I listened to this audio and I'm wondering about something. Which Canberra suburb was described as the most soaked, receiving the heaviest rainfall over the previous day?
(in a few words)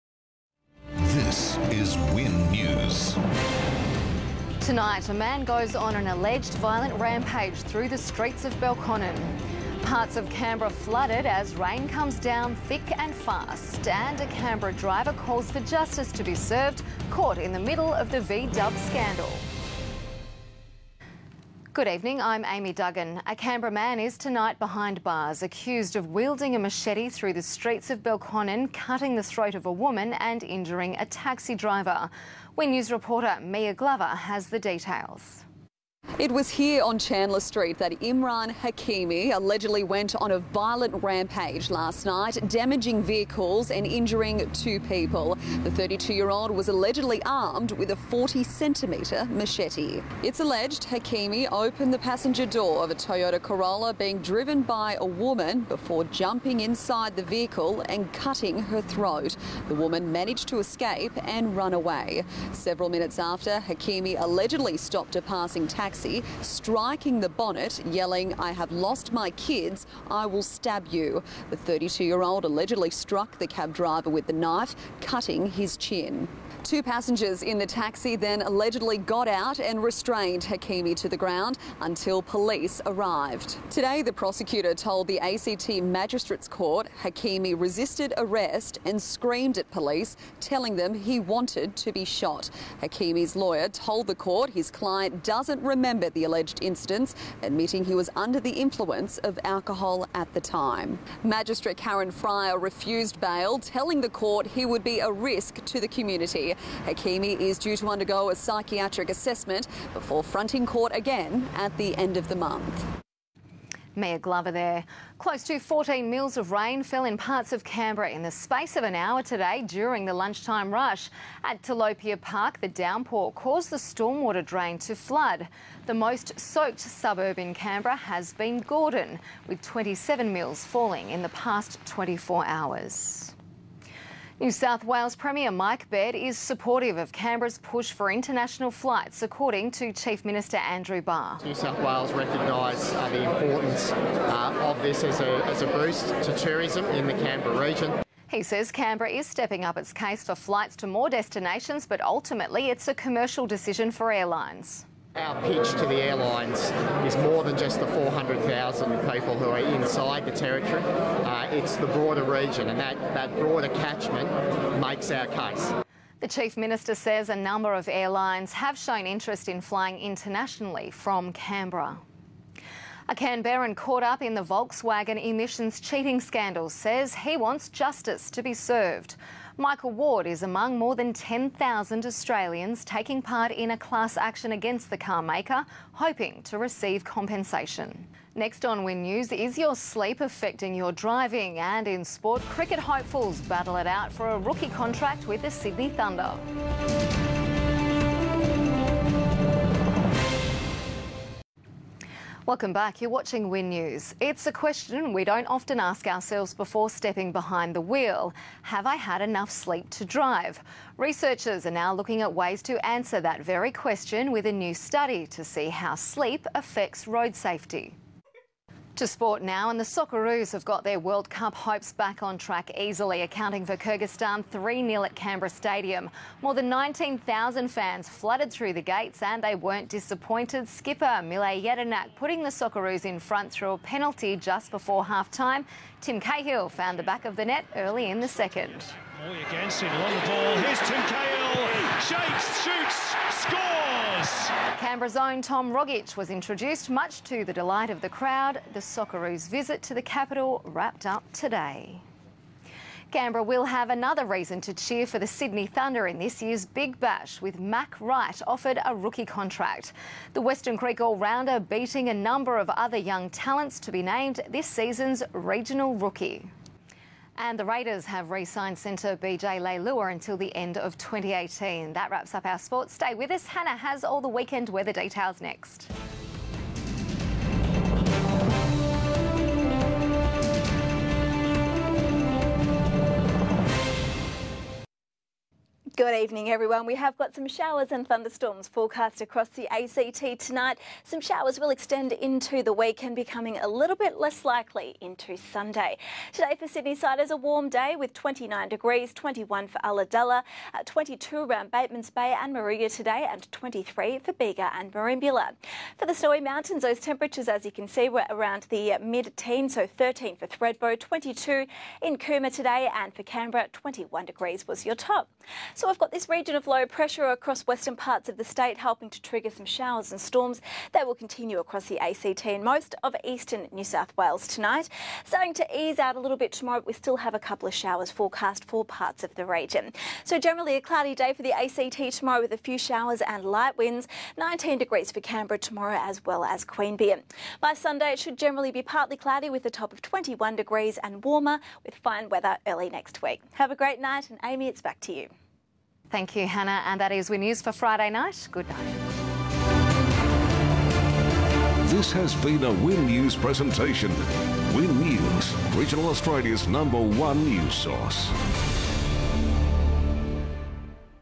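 Gordon.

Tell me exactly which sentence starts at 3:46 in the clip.
More than 19,000 fans flooded through the gates, and they weren't disappointed.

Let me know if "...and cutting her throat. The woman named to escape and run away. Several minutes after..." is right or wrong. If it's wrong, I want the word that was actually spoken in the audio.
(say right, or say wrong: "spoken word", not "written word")
wrong: "managed", not "named".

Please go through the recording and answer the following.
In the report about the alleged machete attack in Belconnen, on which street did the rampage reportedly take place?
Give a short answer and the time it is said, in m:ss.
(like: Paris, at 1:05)
Chandler Street, at 0:36.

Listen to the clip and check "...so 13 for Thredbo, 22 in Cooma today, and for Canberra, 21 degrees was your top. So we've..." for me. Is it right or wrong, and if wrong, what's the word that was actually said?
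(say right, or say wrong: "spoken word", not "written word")
right.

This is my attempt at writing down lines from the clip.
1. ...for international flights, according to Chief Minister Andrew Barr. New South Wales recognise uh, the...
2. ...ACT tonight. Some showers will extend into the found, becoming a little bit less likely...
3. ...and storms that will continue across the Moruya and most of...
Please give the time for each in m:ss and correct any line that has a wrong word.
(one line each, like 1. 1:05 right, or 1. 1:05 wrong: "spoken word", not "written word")
1. 2:17 right
2. 4:49 wrong: "weekend", not "found"
3. 5:20 wrong: "ACT", not "Moruya".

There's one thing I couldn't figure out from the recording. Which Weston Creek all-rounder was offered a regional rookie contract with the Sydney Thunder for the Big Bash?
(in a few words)
Mac Wright.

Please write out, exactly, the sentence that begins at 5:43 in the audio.
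Have a great night and Amy, it's back to you.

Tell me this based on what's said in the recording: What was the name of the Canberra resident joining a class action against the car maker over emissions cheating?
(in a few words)
Michael Ward.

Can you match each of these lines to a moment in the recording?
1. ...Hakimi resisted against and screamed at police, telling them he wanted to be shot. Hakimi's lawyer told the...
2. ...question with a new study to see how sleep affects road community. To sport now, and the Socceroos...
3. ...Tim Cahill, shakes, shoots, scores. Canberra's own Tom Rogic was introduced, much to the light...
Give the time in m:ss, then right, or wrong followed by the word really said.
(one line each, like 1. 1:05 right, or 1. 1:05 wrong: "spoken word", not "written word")
1. 1:27 wrong: "arrest", not "against"
2. 3:33 wrong: "safety", not "community"
3. 4:00 wrong: "delight", not "light".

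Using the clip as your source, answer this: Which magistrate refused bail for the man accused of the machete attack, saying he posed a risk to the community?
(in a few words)
Karen Fryer.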